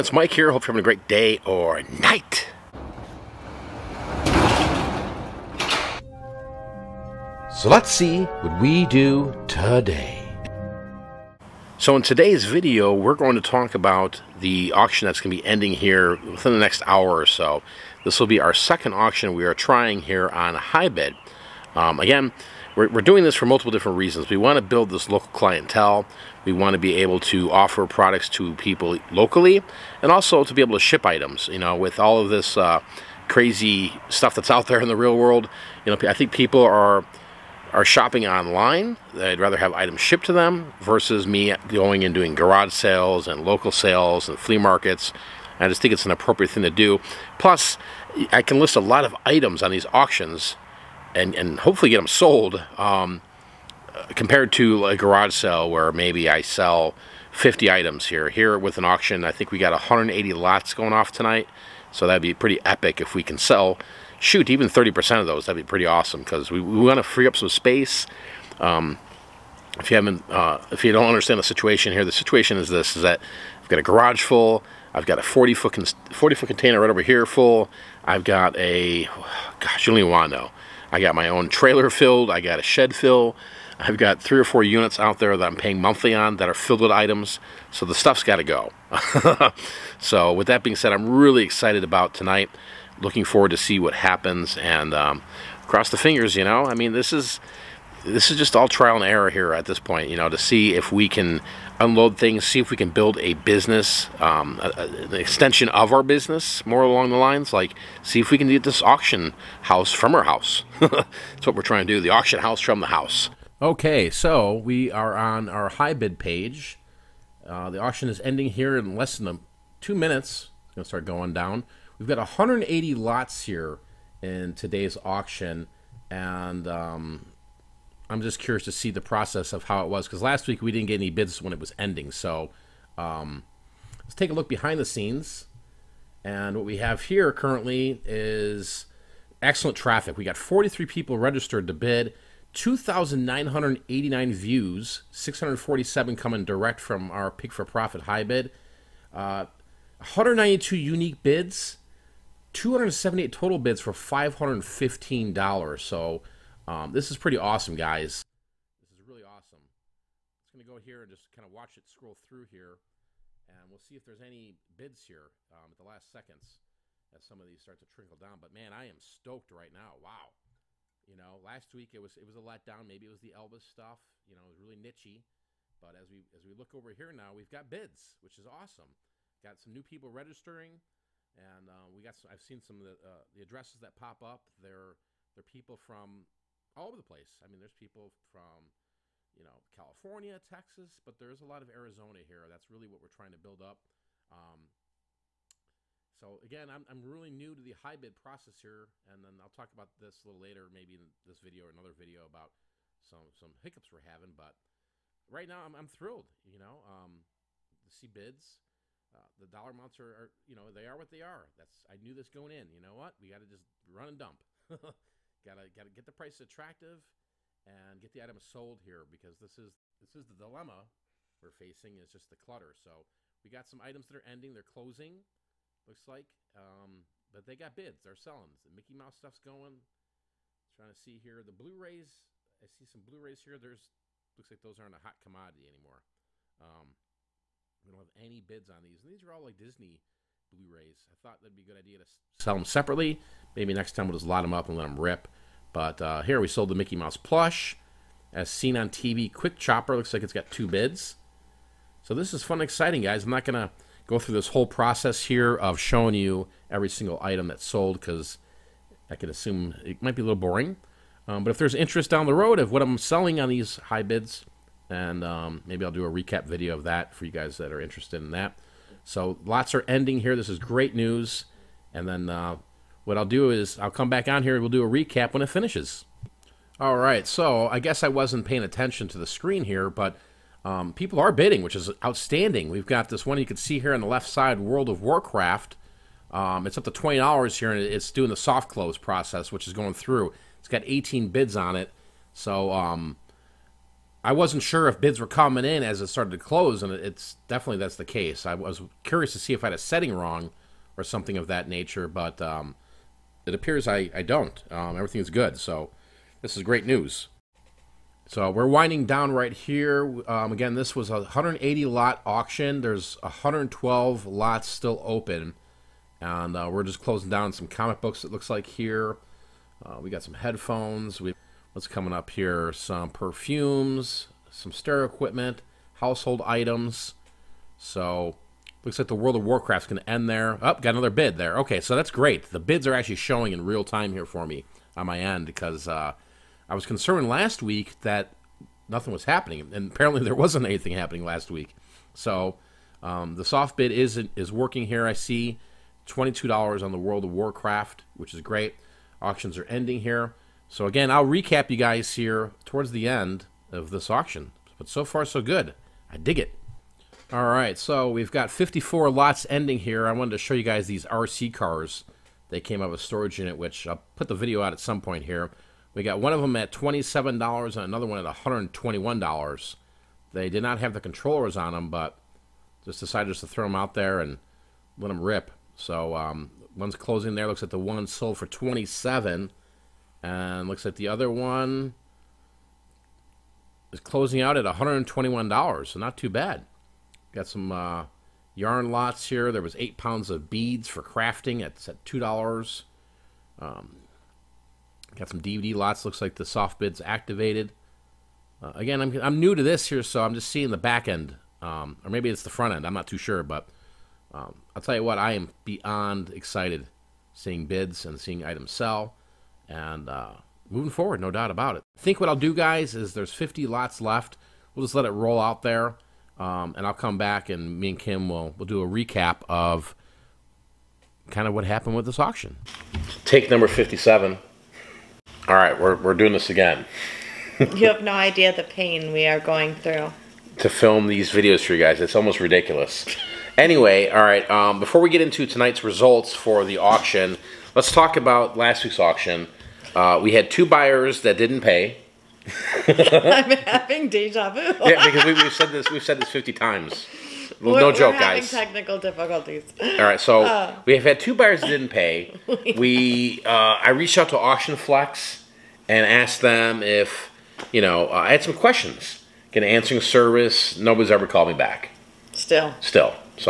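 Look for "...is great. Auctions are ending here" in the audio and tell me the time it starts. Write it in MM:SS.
05:48.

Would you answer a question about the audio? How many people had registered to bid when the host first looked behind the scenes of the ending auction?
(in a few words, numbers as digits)
43.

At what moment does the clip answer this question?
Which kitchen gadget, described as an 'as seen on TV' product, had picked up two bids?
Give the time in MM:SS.
04:09.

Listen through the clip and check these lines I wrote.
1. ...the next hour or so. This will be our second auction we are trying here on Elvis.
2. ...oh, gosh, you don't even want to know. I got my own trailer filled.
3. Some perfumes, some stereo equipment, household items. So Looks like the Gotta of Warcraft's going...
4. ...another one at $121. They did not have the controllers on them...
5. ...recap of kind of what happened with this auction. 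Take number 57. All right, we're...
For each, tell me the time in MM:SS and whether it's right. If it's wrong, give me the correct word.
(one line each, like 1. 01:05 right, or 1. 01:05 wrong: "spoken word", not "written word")
1. 00:16 wrong: "HiBid", not "Elvis"
2. 01:19 right
3. 05:22 wrong: "World", not "Gotta"
4. 06:07 right
5. 06:58 right.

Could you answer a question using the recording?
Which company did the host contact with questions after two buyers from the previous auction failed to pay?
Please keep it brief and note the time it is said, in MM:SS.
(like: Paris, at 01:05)
Auction Flex, at 07:34.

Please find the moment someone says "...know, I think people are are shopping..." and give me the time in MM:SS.
00:35.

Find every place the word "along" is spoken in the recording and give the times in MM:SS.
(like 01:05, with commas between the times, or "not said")
01:46.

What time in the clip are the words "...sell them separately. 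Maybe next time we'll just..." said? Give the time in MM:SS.
04:02.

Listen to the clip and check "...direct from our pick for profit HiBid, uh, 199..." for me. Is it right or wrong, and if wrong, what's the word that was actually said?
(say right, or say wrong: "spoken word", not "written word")
wrong: "192", not "199".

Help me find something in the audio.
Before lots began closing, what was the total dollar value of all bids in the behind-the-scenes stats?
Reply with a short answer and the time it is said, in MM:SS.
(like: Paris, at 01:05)
$515, at 02:33.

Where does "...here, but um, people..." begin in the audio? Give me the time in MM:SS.
04:39.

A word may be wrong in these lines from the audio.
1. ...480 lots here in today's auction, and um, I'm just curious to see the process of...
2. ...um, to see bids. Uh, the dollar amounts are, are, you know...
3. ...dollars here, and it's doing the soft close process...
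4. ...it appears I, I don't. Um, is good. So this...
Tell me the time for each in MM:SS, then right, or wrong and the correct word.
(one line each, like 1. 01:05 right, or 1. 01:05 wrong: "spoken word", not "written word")
1. 02:02 wrong: "180", not "480"
2. 03:26 right
3. 04:47 right
4. 05:03 right.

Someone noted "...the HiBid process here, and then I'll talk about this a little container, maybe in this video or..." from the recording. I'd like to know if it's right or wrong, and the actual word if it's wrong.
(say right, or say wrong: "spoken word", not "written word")
wrong: "later", not "container".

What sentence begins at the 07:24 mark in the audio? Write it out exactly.
yeah, because we, have said this.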